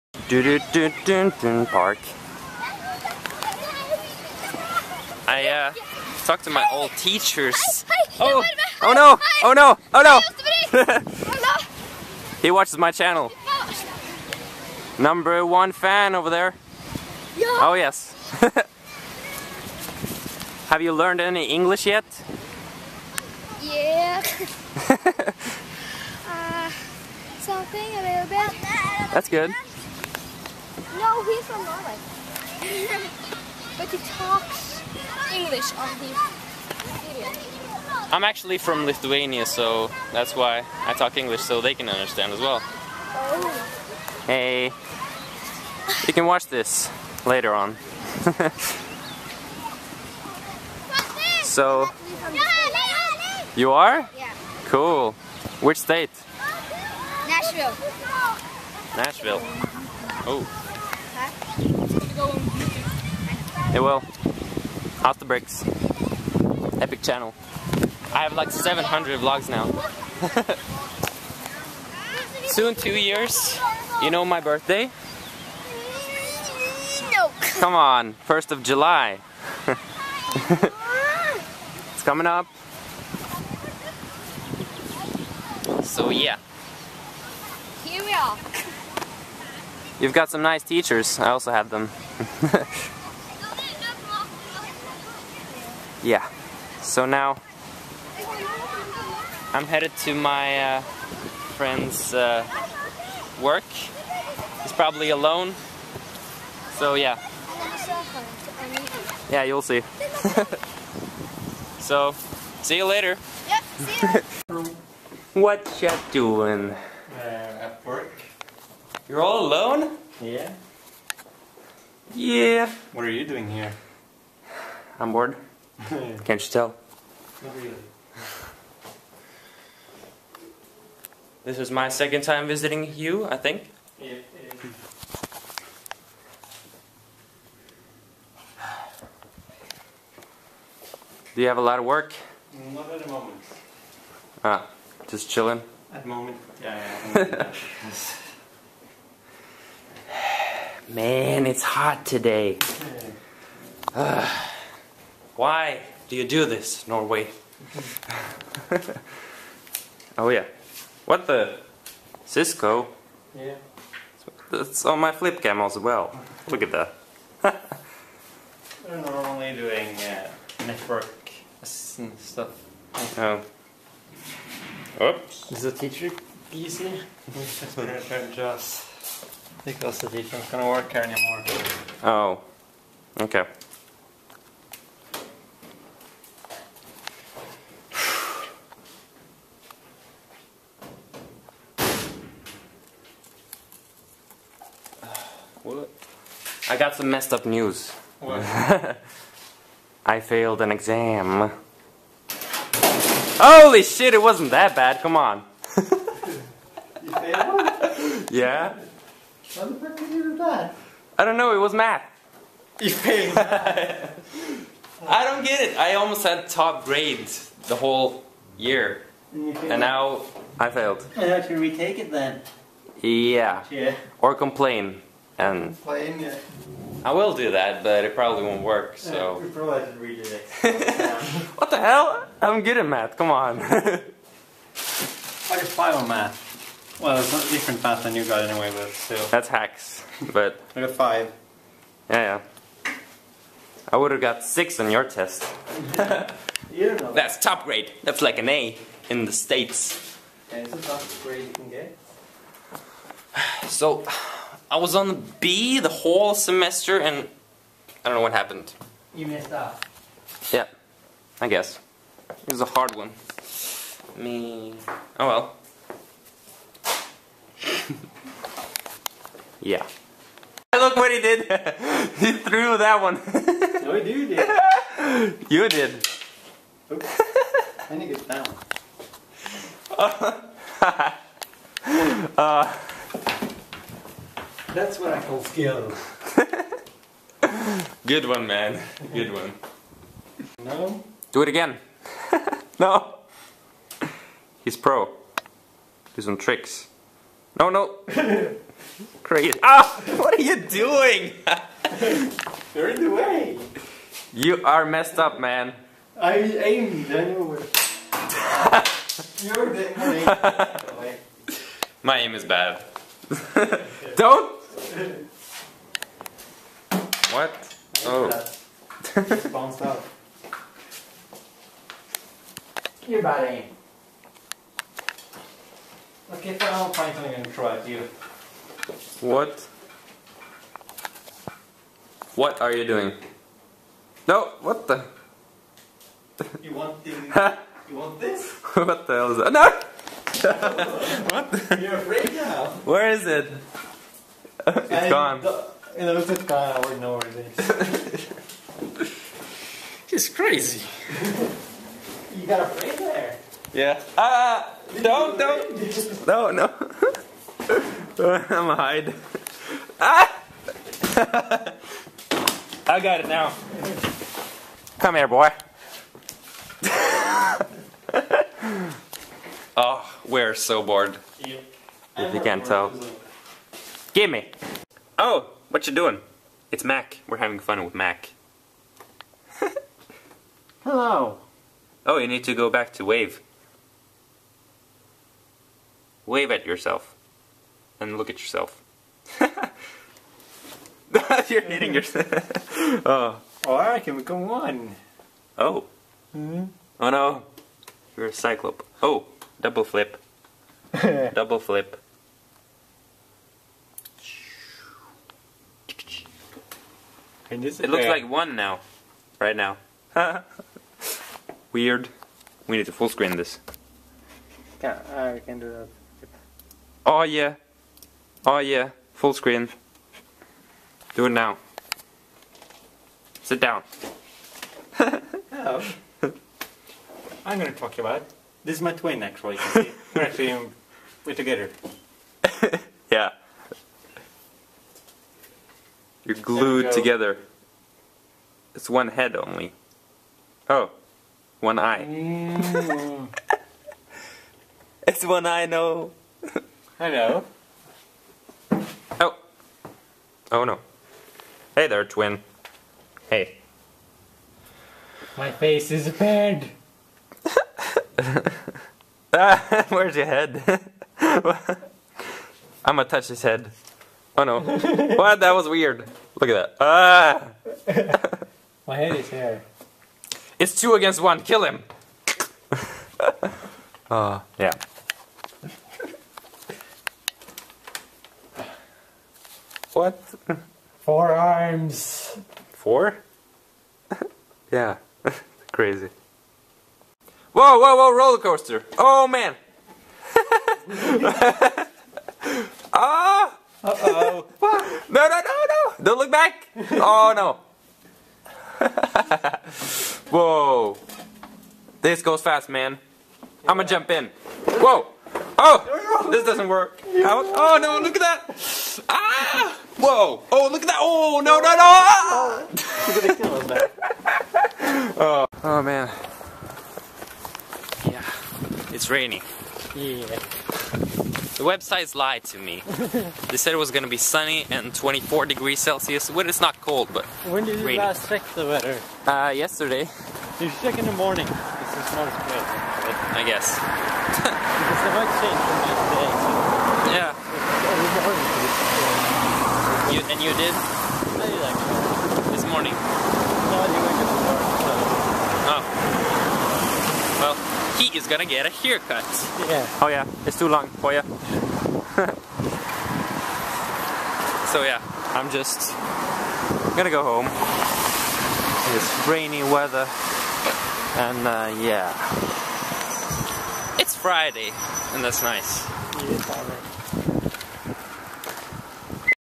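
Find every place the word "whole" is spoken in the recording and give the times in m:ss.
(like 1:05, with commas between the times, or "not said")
3:37, 4:15.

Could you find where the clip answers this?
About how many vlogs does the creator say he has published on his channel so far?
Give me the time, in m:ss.
1:08.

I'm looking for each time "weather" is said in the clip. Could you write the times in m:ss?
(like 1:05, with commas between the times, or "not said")
8:48, 9:19.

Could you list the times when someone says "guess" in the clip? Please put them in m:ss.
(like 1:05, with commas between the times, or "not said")
4:21, 8:53.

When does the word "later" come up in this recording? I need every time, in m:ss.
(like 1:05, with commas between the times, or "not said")
0:47, 1:52.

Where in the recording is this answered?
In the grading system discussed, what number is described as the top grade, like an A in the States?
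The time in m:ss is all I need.
4:04.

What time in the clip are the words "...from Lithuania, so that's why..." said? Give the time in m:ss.
0:38.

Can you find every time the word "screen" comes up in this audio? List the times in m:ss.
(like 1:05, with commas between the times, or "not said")
6:53, 6:59.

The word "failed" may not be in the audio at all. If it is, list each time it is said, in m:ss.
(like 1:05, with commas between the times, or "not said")
3:20, 3:32, 3:40.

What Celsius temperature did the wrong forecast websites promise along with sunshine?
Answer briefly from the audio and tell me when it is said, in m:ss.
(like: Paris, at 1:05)
24 degrees, at 8:44.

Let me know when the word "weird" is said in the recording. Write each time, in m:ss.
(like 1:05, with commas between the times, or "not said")
6:51, 7:45.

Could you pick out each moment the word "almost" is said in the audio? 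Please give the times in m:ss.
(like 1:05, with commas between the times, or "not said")
3:35.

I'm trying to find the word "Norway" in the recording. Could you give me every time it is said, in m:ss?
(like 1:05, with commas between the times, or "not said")
0:31, 2:36.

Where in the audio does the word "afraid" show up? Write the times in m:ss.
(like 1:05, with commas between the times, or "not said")
5:41, 5:52.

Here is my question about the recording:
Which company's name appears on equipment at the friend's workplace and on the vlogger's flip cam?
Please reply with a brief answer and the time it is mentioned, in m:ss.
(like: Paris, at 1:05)
Cisco, at 2:42.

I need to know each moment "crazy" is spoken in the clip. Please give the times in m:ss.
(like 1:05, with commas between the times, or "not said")
4:59, 5:50, 8:05.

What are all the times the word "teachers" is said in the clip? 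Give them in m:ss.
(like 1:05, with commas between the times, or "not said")
0:06, 1:30, 2:55.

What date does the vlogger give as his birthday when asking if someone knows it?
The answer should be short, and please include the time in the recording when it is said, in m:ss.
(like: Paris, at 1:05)
1st of July, at 1:18.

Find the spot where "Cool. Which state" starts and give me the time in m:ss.
0:54.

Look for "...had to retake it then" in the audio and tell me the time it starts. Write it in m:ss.
3:41.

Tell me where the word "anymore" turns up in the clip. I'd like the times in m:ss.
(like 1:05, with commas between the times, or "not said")
3:01.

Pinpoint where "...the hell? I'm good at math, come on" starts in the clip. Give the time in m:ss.
3:51.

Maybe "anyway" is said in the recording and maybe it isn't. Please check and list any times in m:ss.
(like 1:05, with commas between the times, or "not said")
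3:58, 5:07.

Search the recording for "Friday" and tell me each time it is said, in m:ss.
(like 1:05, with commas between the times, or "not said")
9:24.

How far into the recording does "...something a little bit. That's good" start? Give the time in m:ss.
0:27.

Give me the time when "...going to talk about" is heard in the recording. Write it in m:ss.
7:07.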